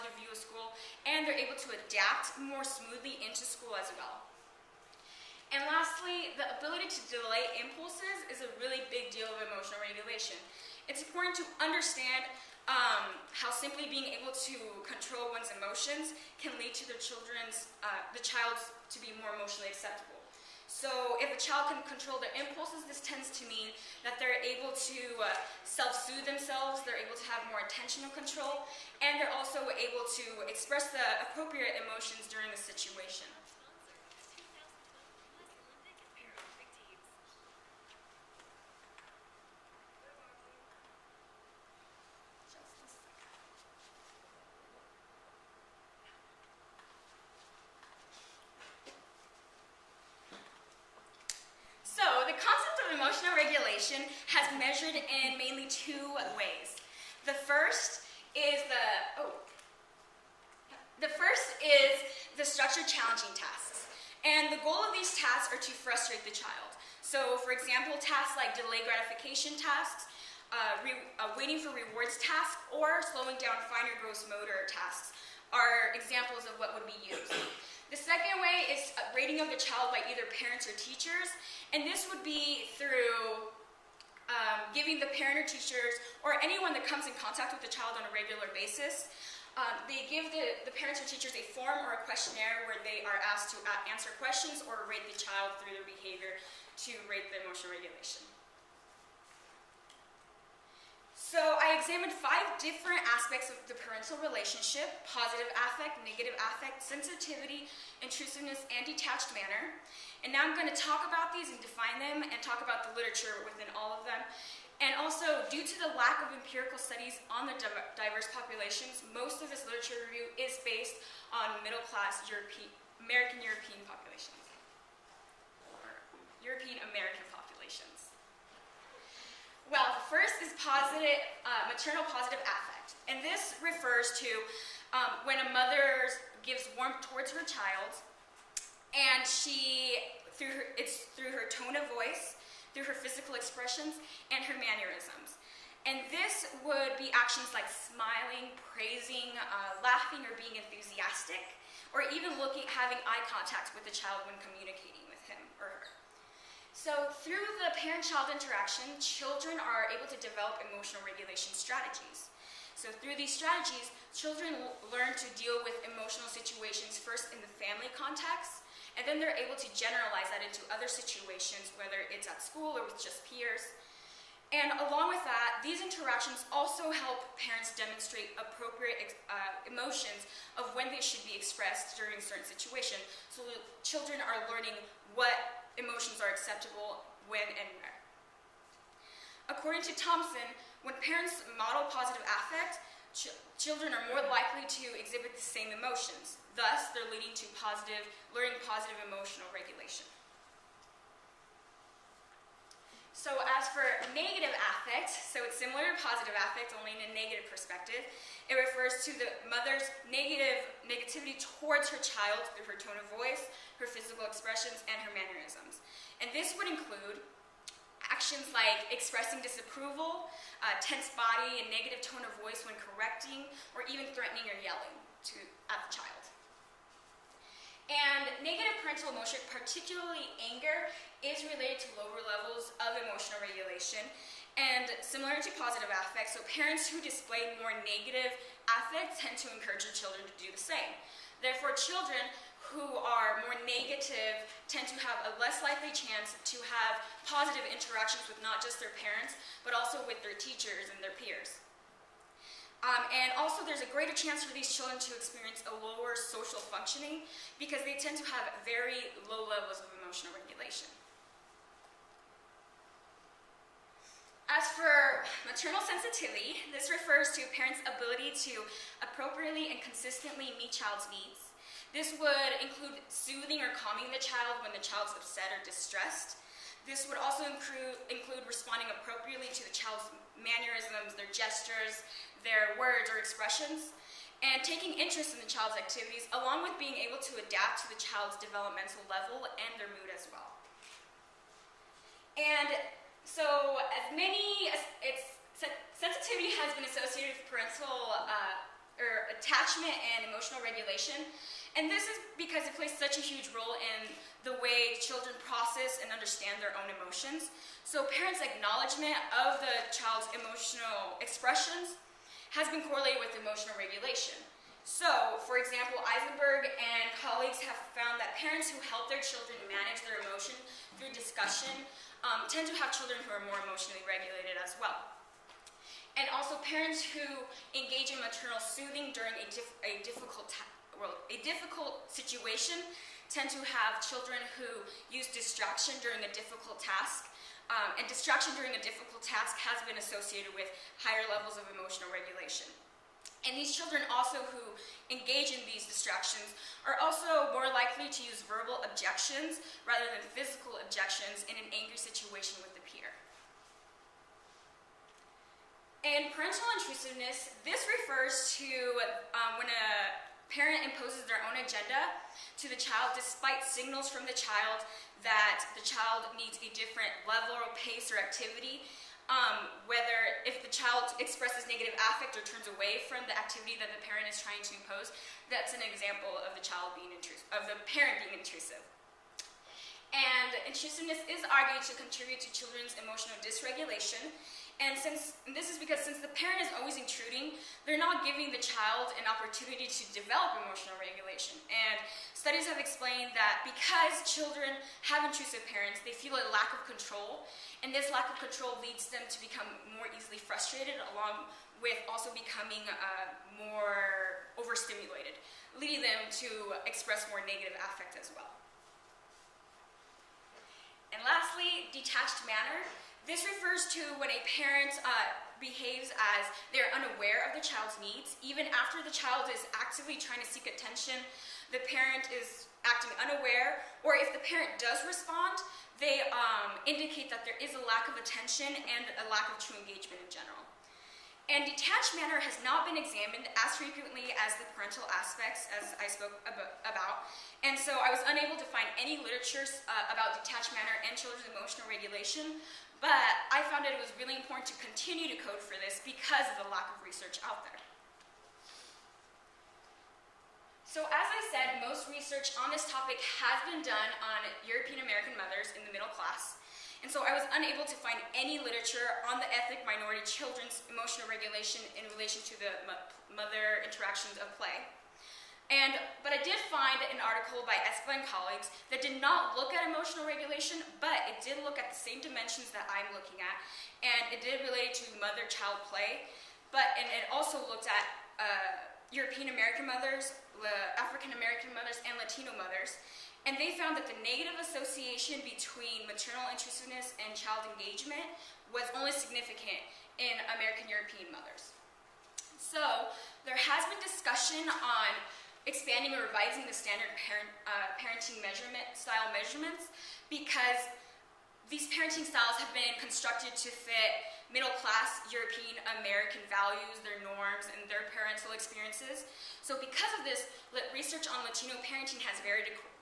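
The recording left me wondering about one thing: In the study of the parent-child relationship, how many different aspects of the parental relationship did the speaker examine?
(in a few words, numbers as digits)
5.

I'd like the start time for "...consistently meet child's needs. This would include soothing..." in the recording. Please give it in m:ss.
4:29.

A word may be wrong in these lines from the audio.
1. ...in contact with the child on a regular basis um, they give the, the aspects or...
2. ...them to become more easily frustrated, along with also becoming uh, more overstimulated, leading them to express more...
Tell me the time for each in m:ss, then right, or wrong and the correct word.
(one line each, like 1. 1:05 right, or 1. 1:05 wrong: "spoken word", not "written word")
1. 1:27 wrong: "parents", not "aspects"
2. 6:39 right.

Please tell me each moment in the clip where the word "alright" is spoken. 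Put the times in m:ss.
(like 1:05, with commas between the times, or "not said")
not said.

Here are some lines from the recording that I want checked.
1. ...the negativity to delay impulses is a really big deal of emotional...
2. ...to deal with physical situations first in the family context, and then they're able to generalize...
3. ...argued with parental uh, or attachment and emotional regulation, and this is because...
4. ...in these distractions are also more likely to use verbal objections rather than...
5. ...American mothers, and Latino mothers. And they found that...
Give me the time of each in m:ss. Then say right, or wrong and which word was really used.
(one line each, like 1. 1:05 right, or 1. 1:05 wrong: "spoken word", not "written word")
1. 0:06 wrong: "ability", not "negativity"
2. 2:45 wrong: "emotional", not "physical"
3. 4:56 wrong: "associated", not "argued"
4. 5:45 right
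5. 8:01 right.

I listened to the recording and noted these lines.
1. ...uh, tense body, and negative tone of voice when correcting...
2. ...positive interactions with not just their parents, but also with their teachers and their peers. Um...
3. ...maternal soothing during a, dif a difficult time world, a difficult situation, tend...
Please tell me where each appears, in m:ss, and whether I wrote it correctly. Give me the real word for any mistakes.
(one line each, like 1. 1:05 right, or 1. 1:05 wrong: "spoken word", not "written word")
1. 3:40 right
2. 4:07 right
3. 5:28 right.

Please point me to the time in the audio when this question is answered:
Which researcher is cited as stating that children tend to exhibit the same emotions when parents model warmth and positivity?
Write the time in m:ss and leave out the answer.
3:09.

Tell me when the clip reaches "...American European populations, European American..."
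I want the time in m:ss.
2:03.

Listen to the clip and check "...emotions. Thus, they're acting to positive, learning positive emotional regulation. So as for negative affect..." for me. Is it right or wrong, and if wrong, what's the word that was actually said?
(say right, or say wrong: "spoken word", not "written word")
wrong: "leading", not "acting".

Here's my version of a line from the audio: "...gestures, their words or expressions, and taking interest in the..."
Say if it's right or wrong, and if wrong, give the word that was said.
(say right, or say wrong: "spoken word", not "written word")
right.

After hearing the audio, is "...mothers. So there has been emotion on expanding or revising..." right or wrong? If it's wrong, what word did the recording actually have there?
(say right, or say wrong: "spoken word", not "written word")
wrong: "discussion", not "emotion".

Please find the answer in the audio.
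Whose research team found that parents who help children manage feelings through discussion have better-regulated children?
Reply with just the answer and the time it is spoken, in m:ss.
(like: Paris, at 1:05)
Eisenberg, at 5:16.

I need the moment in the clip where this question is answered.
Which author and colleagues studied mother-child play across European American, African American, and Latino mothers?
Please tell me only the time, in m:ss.
7:47.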